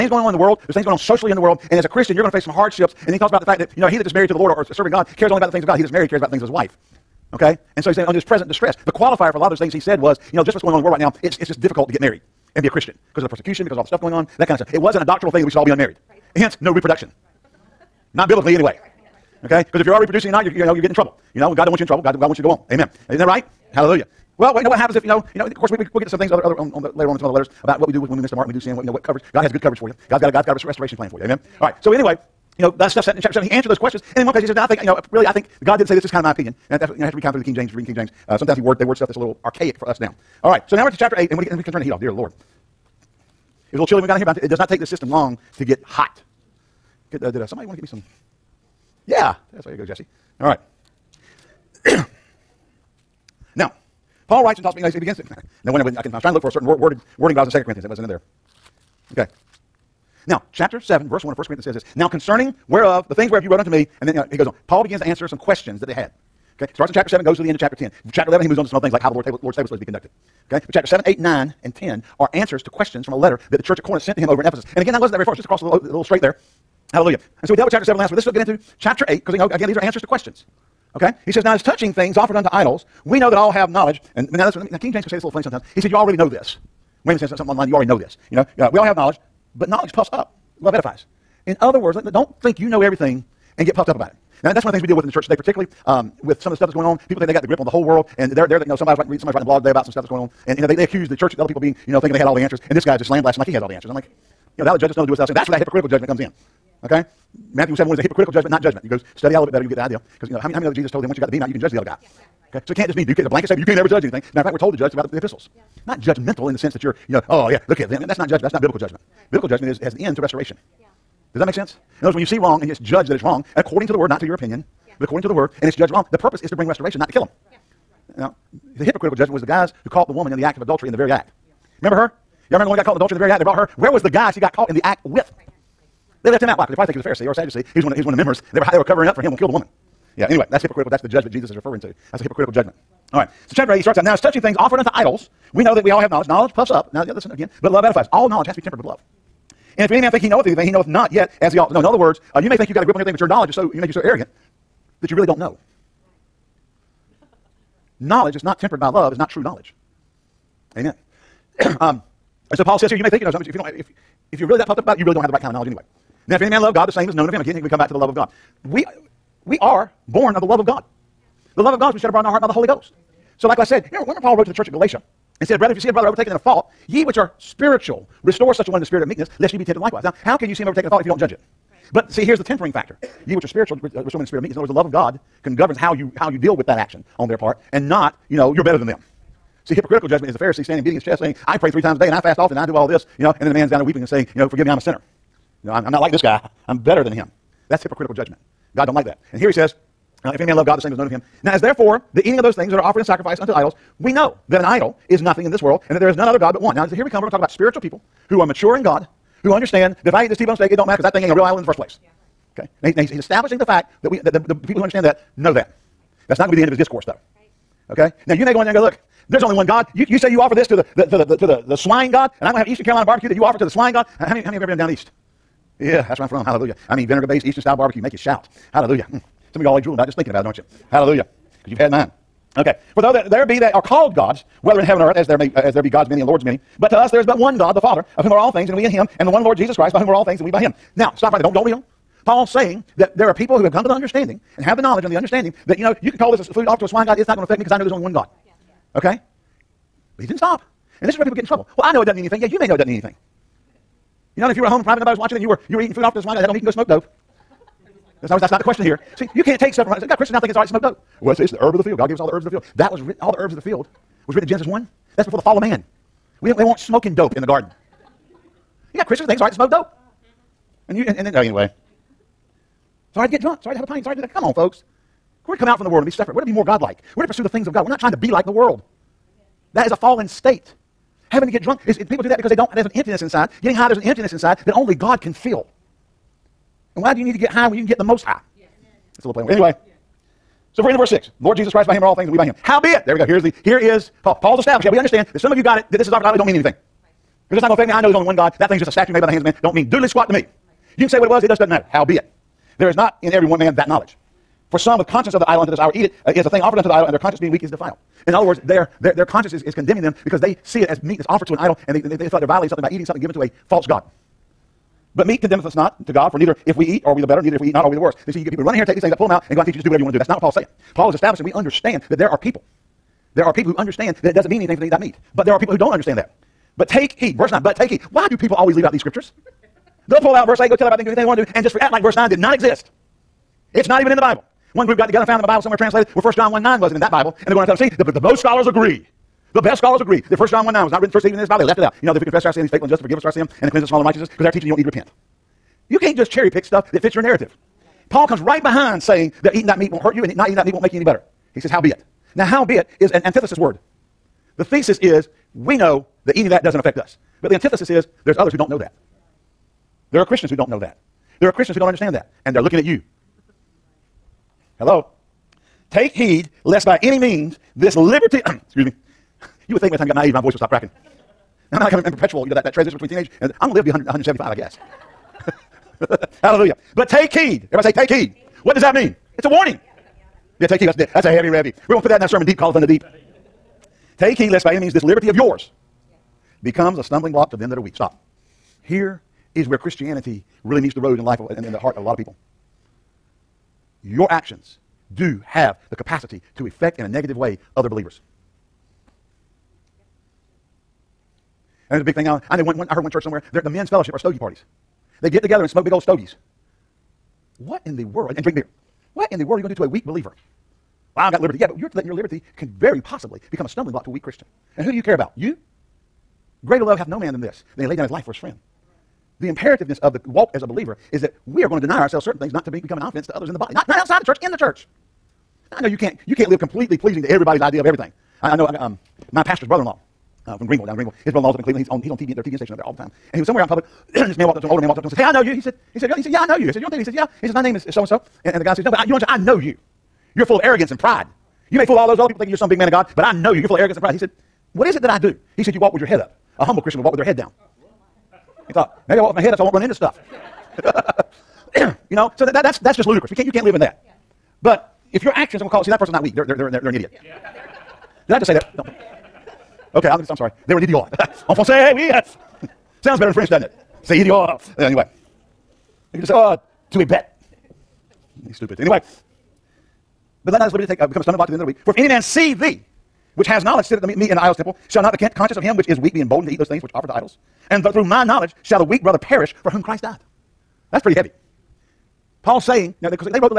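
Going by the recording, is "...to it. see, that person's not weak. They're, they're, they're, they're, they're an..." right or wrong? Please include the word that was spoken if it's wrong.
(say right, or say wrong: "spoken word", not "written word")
right.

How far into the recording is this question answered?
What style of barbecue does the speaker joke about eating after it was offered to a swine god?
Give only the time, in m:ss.
3:42.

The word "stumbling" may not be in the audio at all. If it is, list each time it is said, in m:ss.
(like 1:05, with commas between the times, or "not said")
6:27, 6:53, 7:51.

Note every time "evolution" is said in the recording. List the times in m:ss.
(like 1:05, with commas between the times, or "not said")
not said.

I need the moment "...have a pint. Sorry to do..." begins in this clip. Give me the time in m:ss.
4:33.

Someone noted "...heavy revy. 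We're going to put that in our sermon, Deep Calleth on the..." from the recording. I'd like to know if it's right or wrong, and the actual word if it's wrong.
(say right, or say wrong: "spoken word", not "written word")
right.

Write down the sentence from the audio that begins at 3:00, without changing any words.
Now, how can you see him overtaken in a fault if you don't judge it?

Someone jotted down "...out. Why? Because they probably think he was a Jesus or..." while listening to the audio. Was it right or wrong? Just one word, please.
wrong.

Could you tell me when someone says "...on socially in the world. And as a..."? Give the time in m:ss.
0:00.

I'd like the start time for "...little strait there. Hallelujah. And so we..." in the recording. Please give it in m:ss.
1:15.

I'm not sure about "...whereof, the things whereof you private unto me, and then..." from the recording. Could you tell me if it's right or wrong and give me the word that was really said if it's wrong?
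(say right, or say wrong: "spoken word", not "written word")
wrong: "wrote", not "private".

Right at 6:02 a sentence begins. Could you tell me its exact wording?
And they're looking at you Hello?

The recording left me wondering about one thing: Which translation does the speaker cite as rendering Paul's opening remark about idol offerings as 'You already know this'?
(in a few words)
Weymouth.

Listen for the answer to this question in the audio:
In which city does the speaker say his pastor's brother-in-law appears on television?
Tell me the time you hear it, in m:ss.
7:11.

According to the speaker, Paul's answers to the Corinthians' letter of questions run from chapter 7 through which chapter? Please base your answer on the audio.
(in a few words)
Chapter 10.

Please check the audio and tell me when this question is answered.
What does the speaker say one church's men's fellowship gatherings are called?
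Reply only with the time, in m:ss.
6:44.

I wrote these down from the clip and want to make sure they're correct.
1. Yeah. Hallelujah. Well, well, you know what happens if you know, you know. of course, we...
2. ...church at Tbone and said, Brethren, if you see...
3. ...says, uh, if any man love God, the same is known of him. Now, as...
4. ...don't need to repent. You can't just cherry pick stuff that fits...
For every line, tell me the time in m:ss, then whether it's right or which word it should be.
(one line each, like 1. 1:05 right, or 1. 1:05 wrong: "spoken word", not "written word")
1. 0:23 right
2. 2:54 wrong: "Galatia", not "Tbone"
3. 3:19 right
4. 5:44 right.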